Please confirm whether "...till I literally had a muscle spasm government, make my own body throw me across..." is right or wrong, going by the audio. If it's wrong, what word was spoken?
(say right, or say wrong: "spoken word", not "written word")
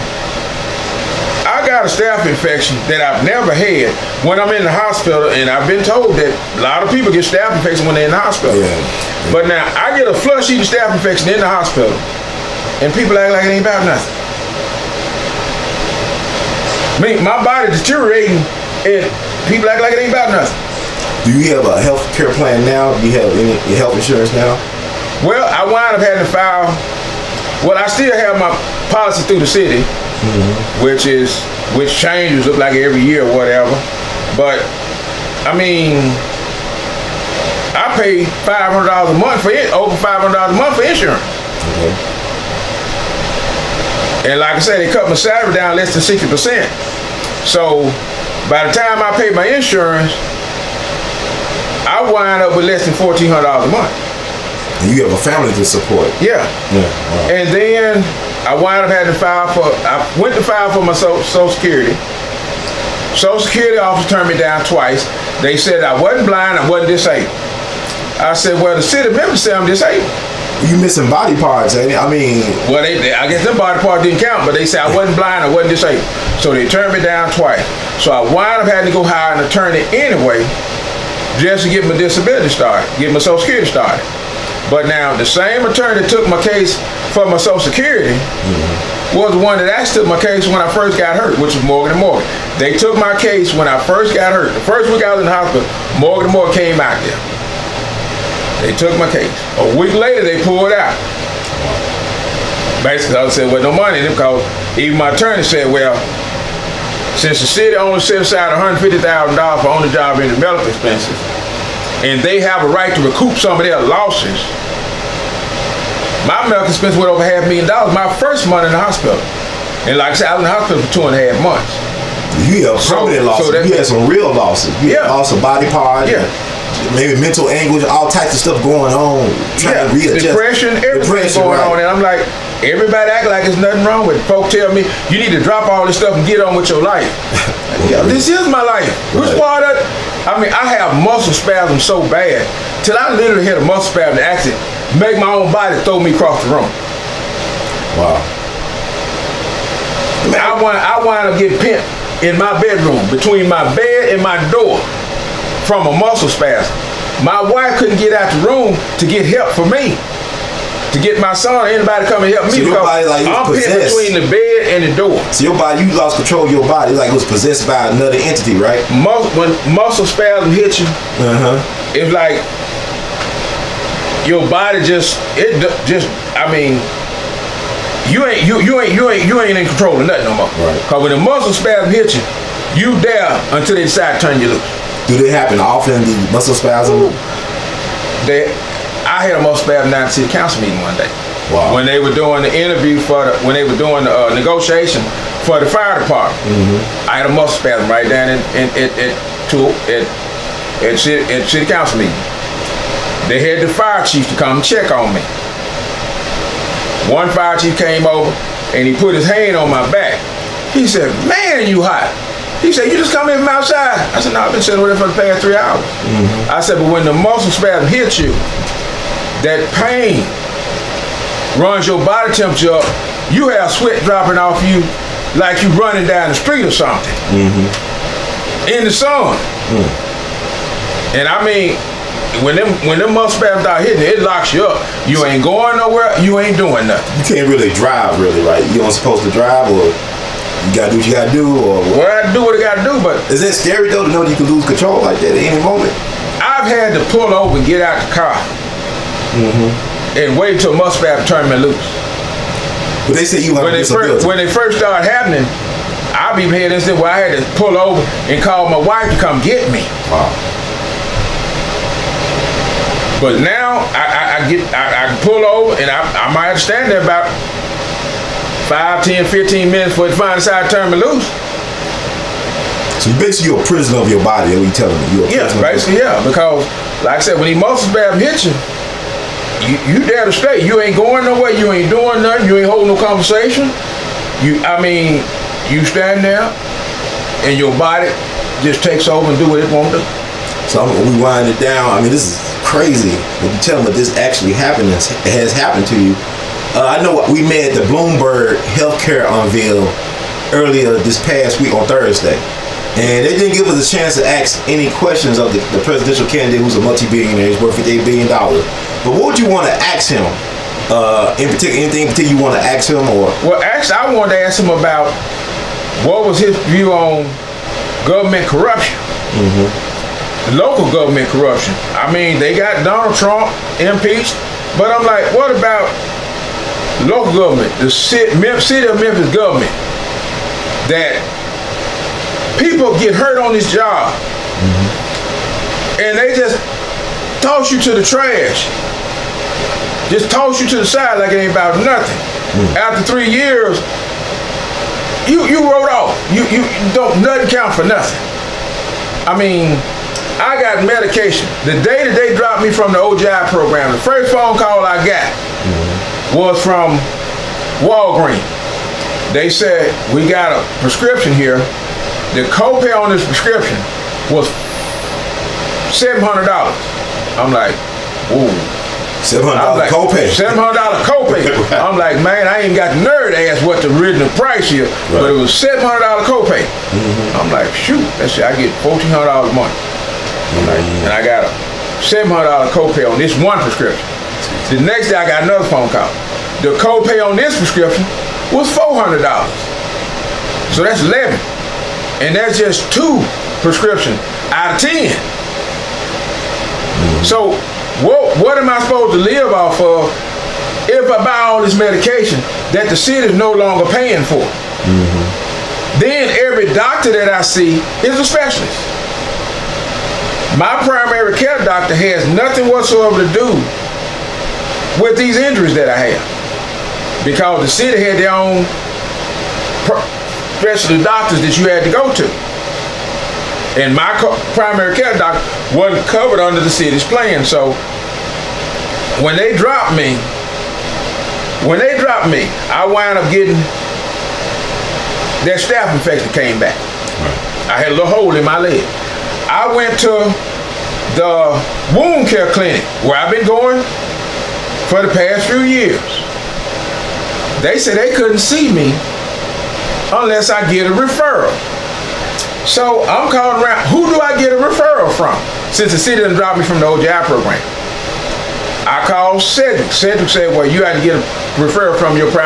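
wrong: "accident", not "government".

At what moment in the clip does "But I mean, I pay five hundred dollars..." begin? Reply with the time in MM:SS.
00:34.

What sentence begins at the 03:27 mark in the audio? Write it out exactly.
One fire chief came over and he put his hand on my back.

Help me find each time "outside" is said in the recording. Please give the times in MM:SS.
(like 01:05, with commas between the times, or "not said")
03:33.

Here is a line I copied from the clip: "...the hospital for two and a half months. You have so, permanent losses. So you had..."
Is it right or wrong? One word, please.
right.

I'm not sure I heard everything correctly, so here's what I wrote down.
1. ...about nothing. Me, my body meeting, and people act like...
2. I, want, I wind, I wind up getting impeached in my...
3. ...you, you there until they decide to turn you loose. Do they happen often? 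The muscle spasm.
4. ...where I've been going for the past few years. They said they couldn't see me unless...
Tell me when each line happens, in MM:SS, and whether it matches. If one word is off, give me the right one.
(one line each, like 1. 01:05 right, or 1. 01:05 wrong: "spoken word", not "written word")
1. 00:13 wrong: "deteriorating", not "meeting"
2. 02:30 wrong: "pimped", not "impeached"
3. 03:02 right
4. 07:23 right.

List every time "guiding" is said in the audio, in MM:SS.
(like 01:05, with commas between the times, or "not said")
not said.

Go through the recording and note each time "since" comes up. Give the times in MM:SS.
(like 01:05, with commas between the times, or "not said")
01:47, 07:35.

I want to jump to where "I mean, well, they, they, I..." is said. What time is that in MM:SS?
01:11.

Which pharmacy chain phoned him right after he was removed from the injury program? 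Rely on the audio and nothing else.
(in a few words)
Walgreens.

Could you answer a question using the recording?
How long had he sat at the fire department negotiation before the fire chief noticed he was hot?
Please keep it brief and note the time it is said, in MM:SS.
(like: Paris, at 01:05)
3 hours, at 03:35.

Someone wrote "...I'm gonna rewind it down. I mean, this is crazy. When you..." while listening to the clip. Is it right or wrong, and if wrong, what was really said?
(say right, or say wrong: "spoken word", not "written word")
right.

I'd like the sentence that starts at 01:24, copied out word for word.
But now the same attorney that took my case for my Social Security mm -hmm.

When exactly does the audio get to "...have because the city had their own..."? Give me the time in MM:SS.
06:56.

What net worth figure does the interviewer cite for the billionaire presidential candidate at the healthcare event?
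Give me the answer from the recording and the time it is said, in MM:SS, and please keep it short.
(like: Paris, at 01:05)
$58 billion, at 05:07.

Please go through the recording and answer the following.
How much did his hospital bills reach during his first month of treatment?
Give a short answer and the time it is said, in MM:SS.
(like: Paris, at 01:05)
Half a million dollars, at 01:57.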